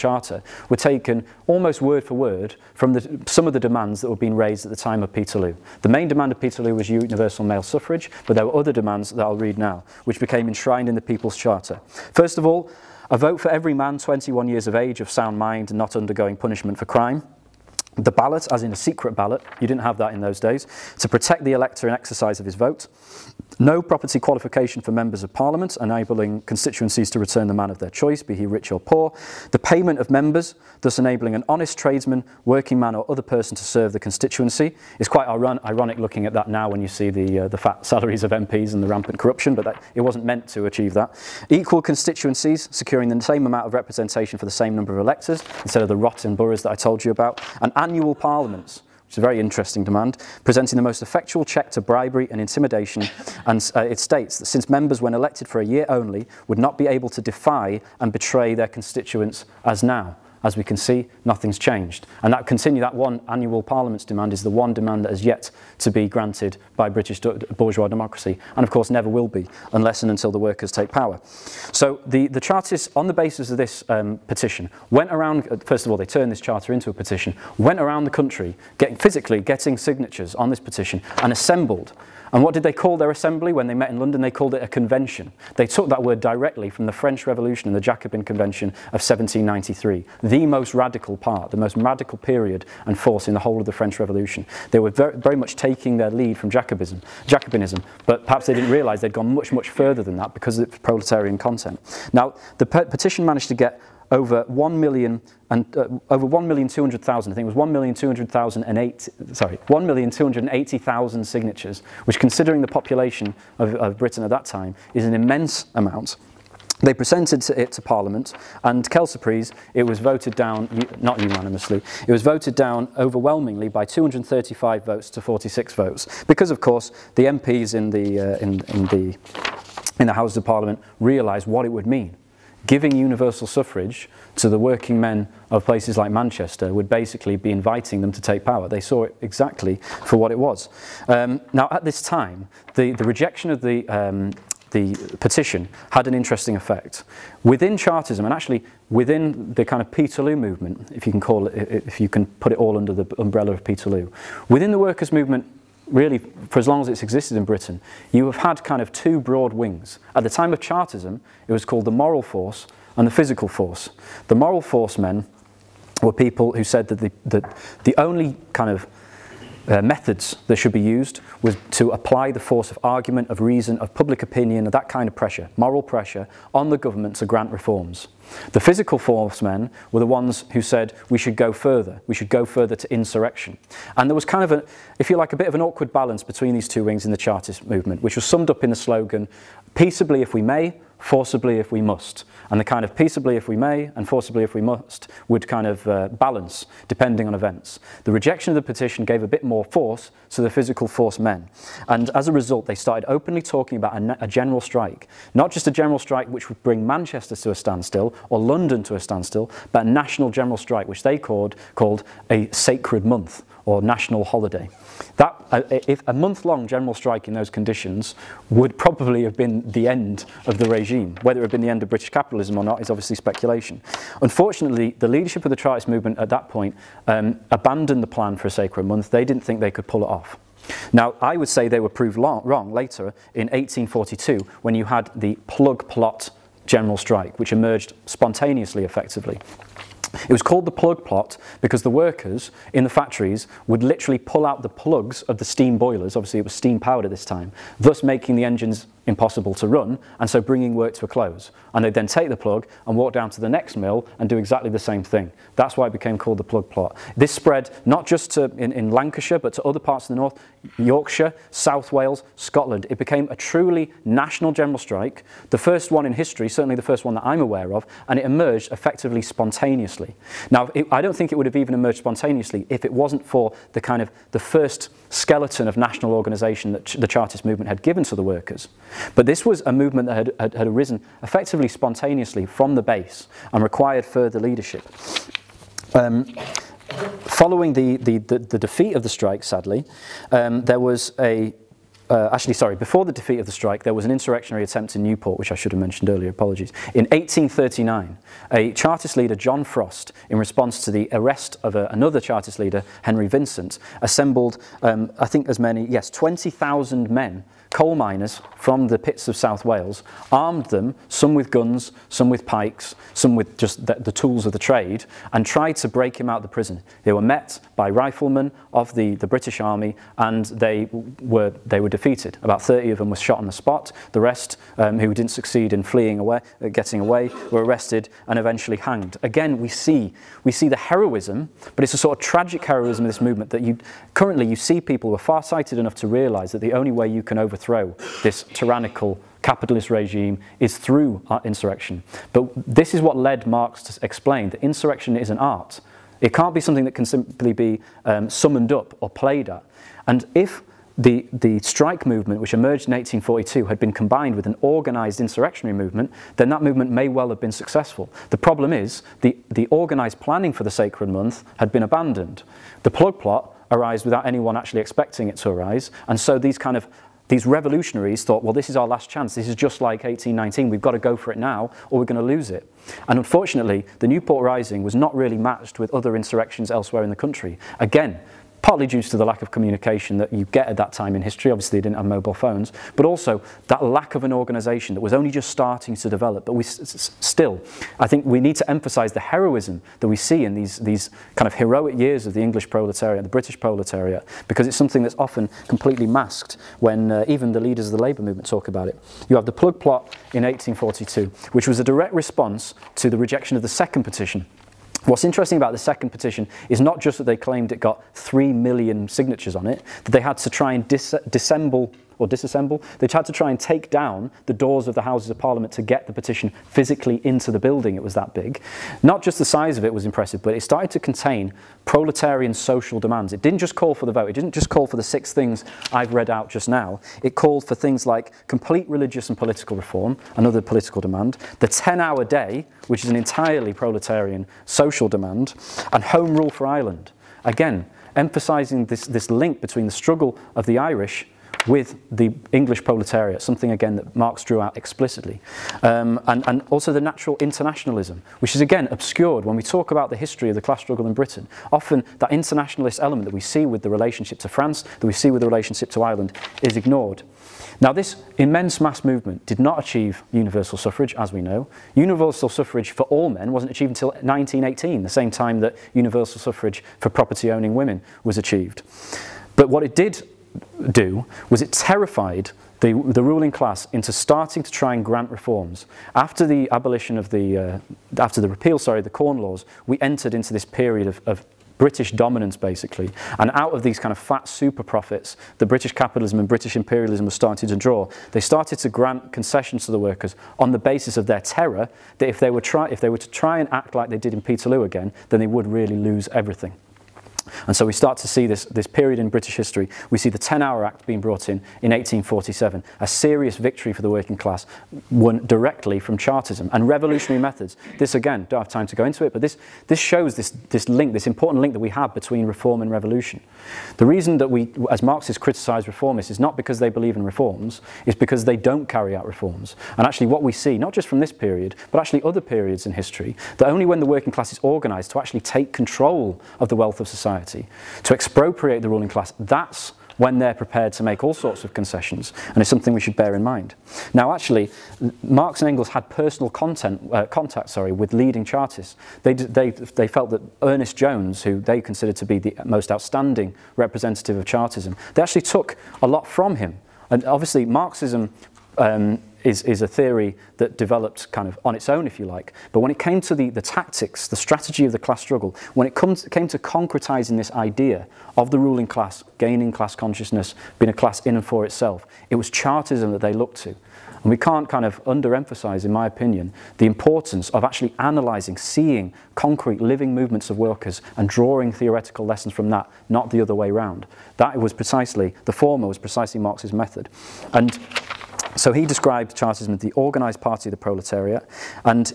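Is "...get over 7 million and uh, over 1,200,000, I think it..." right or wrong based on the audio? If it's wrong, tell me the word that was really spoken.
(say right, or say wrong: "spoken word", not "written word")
wrong: "1", not "7".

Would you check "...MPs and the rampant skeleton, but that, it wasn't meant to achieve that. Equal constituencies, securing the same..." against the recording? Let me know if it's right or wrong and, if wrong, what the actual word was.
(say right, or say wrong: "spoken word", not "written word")
wrong: "corruption", not "skeleton".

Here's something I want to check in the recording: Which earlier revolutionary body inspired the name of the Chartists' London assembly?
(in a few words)
Jacobin Convention of 1793.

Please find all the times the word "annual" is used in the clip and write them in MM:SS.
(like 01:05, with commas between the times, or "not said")
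00:47, 01:03.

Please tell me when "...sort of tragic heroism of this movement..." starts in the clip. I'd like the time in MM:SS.
05:31.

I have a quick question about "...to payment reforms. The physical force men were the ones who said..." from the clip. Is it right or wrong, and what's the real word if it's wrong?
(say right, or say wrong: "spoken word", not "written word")
wrong: "grant", not "payment".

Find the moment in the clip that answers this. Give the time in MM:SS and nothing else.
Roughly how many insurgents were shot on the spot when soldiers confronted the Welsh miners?
05:22.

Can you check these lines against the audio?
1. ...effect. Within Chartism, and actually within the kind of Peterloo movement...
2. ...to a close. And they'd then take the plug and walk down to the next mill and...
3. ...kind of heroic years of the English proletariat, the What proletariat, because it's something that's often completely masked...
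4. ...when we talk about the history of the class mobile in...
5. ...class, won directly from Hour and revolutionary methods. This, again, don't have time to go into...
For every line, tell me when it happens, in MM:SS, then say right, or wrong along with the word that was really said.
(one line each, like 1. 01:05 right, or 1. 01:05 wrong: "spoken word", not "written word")
1. 02:26 right
2. 04:10 right
3. 06:31 wrong: "British", not "What"
4. 07:29 wrong: "struggle", not "mobile"
5. 08:24 wrong: "Chartism", not "Hour".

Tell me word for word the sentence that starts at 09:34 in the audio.
That was precisely, the former was precisely Marx's method.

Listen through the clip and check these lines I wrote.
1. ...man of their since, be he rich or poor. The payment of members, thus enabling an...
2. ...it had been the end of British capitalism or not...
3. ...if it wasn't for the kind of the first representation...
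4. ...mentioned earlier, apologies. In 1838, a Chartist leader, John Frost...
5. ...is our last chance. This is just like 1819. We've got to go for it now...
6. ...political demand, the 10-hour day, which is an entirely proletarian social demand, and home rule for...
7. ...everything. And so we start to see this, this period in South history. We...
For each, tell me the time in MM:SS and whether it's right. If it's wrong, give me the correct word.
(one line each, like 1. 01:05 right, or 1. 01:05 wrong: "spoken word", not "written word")
1. 00:27 wrong: "choice", not "since"
2. 03:41 right
3. 04:32 wrong: "skeleton", not "representation"
4. 04:55 wrong: "1839", not "1838"
5. 06:08 right
6. 07:10 right
7. 08:16 wrong: "British", not "South".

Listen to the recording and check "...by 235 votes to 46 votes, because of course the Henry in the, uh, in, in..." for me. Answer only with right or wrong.
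wrong.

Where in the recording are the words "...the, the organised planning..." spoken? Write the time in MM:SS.
05:59.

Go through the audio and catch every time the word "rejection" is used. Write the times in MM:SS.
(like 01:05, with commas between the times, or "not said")
02:23, 03:18, 06:43.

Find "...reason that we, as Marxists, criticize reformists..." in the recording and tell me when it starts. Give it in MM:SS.
08:34.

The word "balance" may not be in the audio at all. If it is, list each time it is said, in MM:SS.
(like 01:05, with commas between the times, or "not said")
03:05, 03:16.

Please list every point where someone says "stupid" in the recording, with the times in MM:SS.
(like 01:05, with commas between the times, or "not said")
not said.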